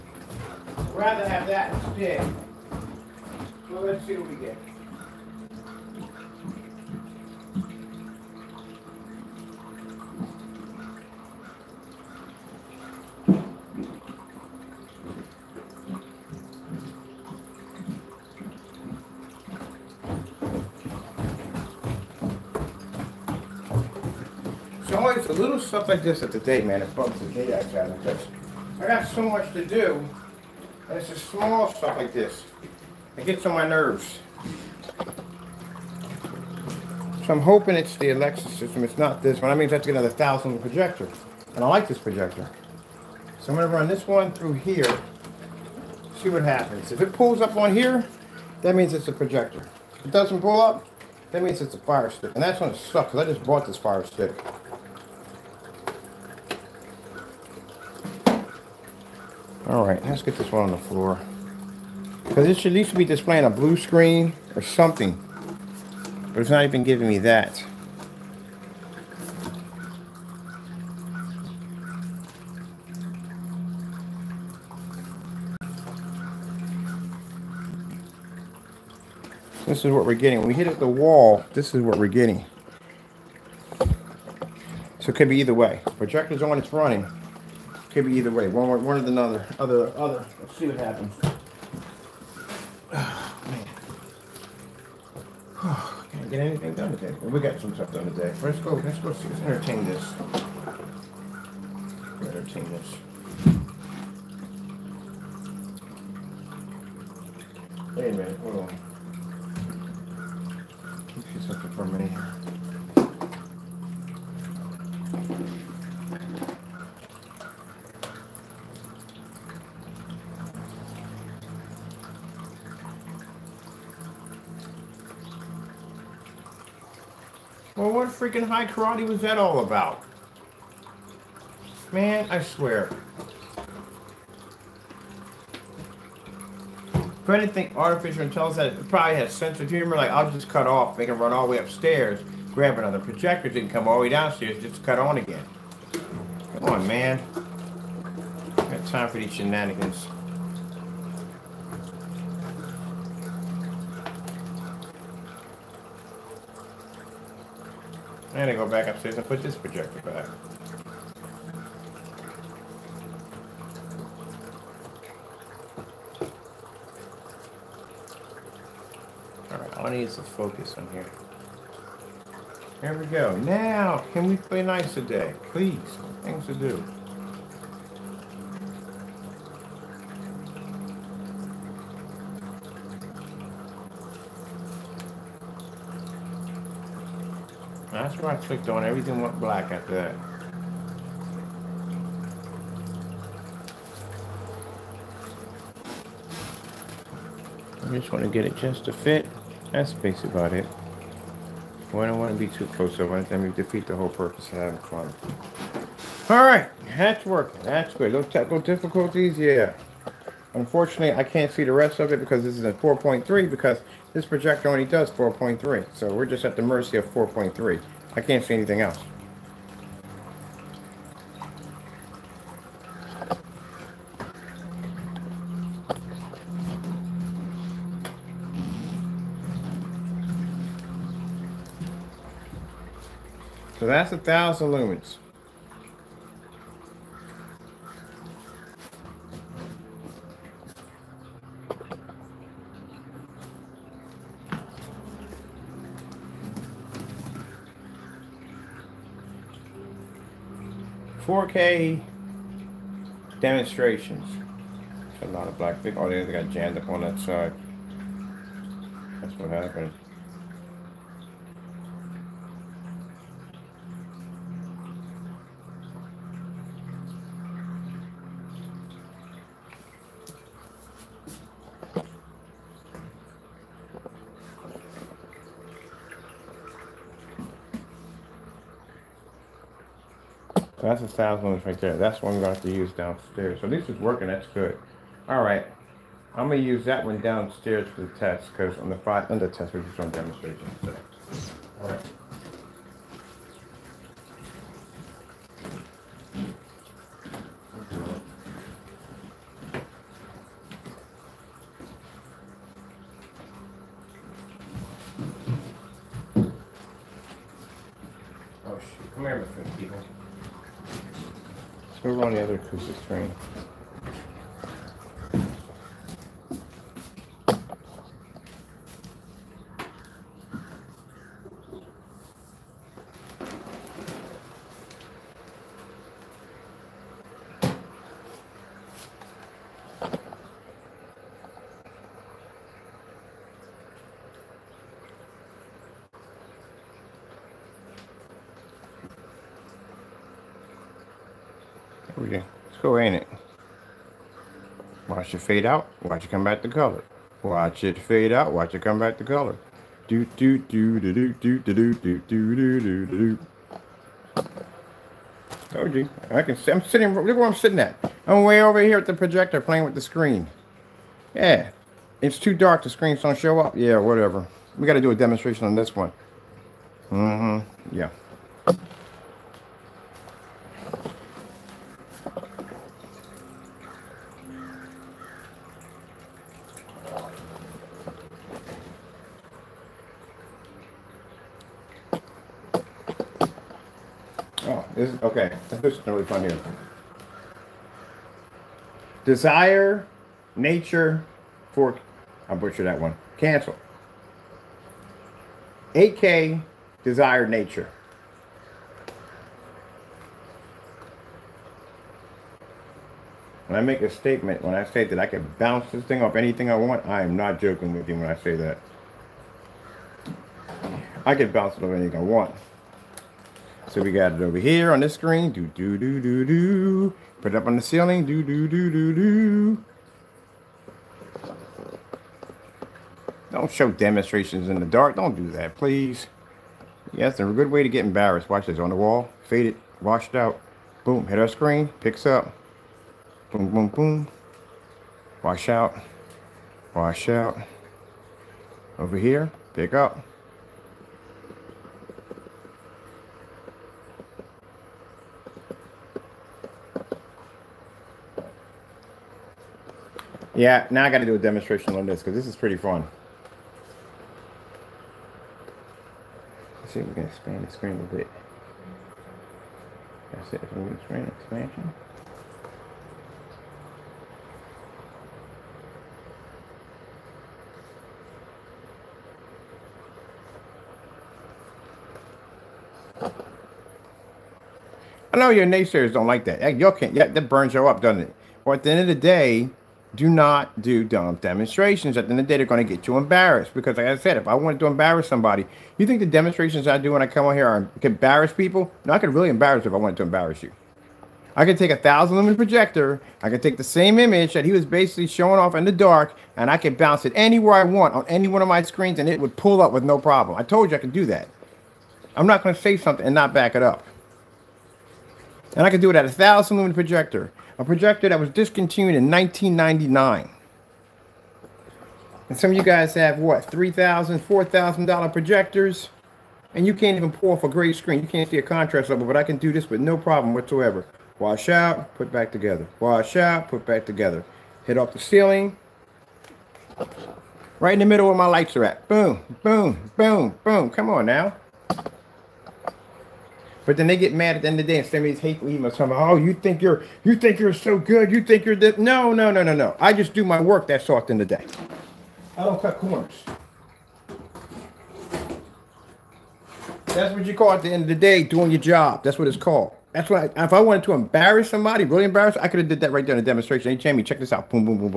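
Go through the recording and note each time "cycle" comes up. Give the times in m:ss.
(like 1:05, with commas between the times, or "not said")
not said.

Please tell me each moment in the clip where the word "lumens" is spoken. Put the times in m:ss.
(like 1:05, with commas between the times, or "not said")
3:54, 4:41, 8:12, 8:26.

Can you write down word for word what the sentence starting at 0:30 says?
And it's just small stuff like this.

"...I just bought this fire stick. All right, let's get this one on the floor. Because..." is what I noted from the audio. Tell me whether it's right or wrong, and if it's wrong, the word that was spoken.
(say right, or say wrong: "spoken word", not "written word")
right.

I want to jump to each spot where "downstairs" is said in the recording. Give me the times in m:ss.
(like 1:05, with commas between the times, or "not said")
2:24, 4:42, 4:47.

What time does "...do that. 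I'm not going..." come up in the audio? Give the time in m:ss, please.
8:21.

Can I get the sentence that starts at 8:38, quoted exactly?
You can't see a contrast level, but I can do this with no problem whatsoever.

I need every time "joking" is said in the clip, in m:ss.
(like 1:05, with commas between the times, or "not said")
6:47.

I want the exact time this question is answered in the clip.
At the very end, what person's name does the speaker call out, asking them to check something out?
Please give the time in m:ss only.
9:13.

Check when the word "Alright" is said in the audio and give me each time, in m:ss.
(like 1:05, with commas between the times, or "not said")
2:49, 3:26.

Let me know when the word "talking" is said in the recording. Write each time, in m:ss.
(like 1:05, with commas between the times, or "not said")
8:55.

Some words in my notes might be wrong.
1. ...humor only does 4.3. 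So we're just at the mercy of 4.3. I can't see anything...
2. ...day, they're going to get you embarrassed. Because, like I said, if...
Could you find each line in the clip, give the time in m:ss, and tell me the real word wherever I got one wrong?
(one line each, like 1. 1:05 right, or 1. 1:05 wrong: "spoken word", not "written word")
1. 3:34 wrong: "projector", not "humor"
2. 8:02 right.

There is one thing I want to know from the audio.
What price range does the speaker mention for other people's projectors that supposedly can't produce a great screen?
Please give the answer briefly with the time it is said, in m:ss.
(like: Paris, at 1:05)
$3,000 to $4,000, at 8:33.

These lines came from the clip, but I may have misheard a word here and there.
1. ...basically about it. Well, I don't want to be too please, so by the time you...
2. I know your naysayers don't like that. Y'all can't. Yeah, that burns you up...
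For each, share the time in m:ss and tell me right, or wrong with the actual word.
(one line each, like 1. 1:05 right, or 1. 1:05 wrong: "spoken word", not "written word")
1. 3:19 wrong: "close", not "please"
2. 7:55 right.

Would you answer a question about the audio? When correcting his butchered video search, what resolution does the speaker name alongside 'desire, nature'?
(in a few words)
8K.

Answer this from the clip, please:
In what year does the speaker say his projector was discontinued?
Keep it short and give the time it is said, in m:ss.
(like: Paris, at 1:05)
1999, at 8:29.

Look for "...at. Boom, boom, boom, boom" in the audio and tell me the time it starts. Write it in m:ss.
8:48.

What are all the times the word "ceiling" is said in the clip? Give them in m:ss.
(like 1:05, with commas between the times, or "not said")
6:57, 8:45.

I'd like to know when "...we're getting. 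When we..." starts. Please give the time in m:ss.
1:20.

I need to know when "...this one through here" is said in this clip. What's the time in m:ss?
0:43.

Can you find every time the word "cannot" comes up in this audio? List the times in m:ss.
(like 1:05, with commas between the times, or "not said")
not said.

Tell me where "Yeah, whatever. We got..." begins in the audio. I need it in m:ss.
6:03.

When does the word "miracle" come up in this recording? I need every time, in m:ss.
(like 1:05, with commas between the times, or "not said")
not said.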